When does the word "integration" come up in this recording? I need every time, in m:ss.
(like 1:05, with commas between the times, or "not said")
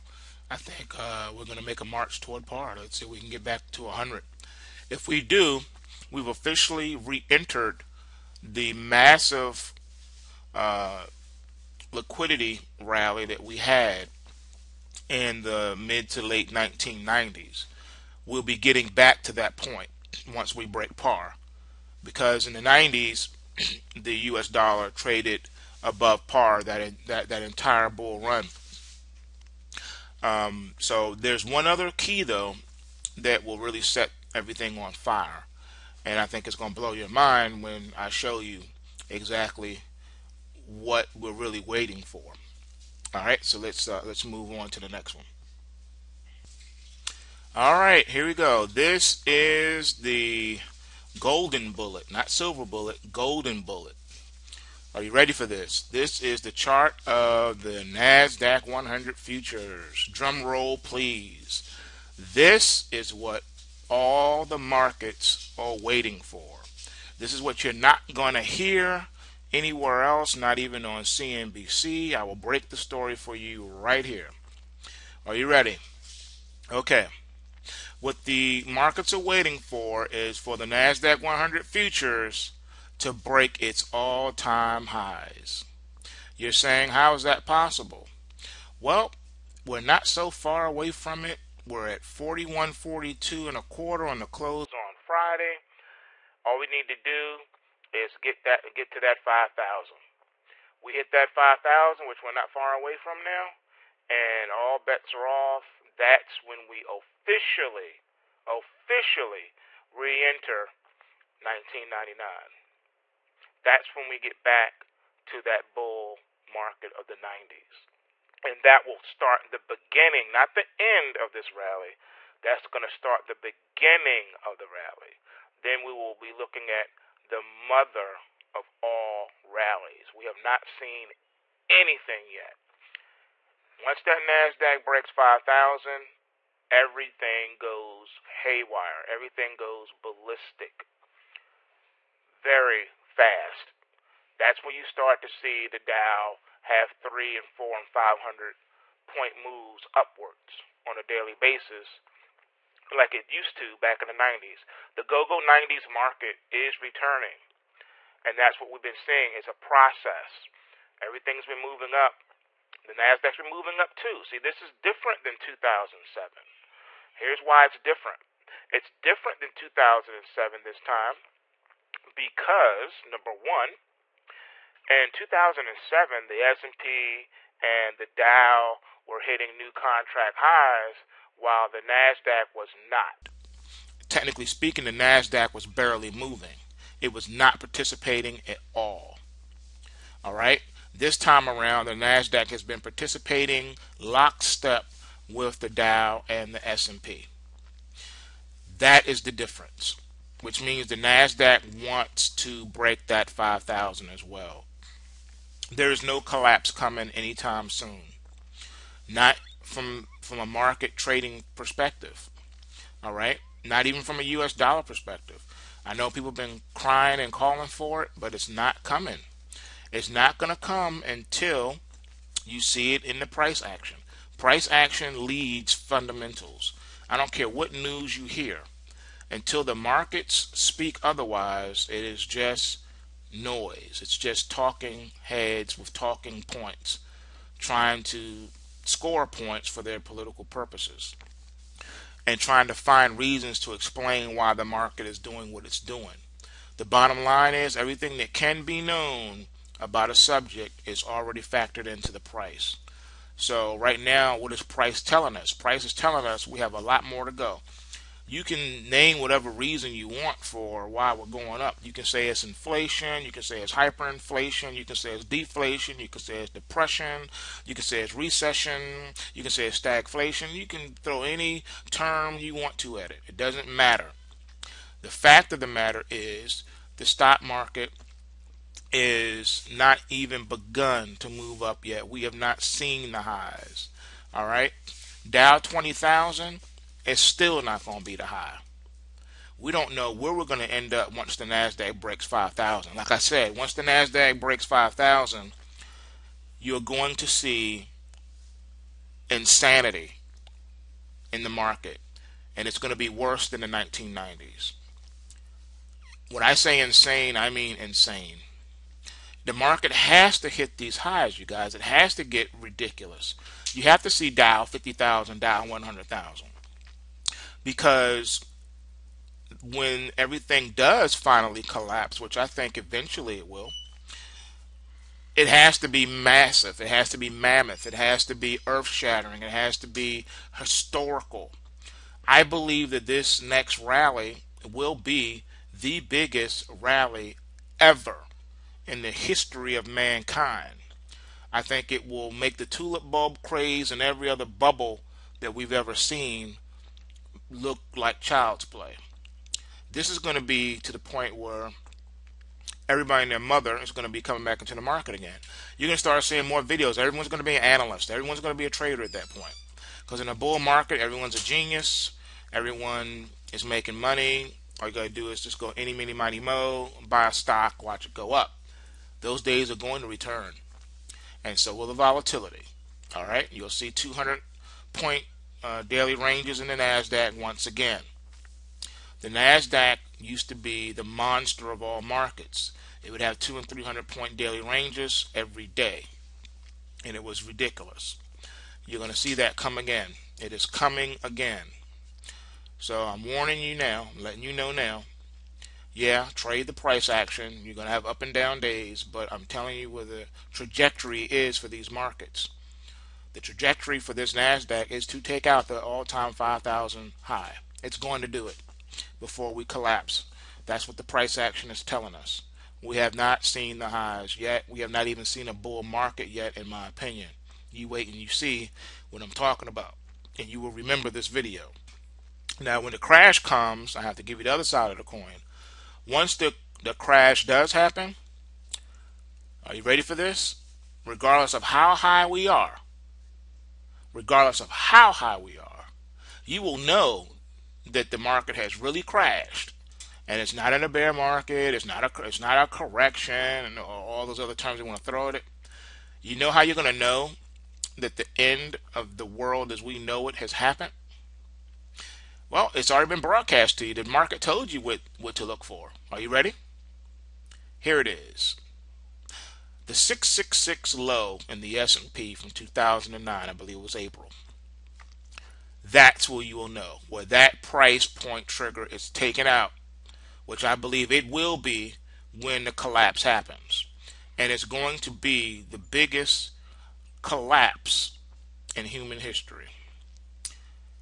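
not said.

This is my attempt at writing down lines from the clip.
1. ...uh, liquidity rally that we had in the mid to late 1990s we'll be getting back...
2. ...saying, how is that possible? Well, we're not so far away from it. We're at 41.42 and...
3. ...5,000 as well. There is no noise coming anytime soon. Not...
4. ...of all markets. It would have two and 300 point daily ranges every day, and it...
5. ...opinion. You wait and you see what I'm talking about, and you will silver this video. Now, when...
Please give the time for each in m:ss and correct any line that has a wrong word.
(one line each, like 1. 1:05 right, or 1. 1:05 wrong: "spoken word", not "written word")
1. 0:10 right
2. 1:26 right
3. 3:23 wrong: "collapse", not "noise"
4. 6:21 right
5. 6:56 wrong: "remember", not "silver".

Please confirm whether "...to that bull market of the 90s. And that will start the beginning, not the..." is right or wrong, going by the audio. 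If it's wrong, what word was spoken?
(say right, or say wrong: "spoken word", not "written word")
right.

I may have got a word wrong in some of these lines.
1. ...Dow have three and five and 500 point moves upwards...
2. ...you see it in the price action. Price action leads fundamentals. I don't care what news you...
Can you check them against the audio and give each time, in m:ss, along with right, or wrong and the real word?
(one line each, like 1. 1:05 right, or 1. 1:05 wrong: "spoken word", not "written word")
1. 2:25 wrong: "four", not "five"
2. 3:42 right.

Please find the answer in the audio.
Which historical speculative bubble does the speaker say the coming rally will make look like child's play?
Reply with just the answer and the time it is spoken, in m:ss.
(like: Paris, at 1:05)
tulip bulb craze, at 5:42.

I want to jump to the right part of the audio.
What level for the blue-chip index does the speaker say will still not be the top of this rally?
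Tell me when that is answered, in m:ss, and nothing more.
4:45.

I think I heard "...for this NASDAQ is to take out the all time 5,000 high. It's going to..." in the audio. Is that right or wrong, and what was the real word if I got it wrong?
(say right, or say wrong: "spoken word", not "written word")
right.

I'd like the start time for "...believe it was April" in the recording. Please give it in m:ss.
7:43.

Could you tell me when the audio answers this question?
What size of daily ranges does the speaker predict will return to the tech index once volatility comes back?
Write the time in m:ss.
6:13.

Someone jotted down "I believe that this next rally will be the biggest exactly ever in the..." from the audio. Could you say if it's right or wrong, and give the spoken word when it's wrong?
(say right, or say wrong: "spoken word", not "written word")
wrong: "rally", not "exactly".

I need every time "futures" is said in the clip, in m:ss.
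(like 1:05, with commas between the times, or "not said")
0:59, 1:21.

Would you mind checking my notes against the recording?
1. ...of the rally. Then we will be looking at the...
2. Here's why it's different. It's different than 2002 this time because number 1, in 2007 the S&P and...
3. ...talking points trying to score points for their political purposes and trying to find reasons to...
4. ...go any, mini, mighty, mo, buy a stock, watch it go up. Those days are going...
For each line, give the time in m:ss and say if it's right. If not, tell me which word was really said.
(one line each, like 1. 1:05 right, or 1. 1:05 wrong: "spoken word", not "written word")
1. 2:04 right
2. 2:47 wrong: "2007", not "2002"
3. 3:55 right
4. 6:05 right.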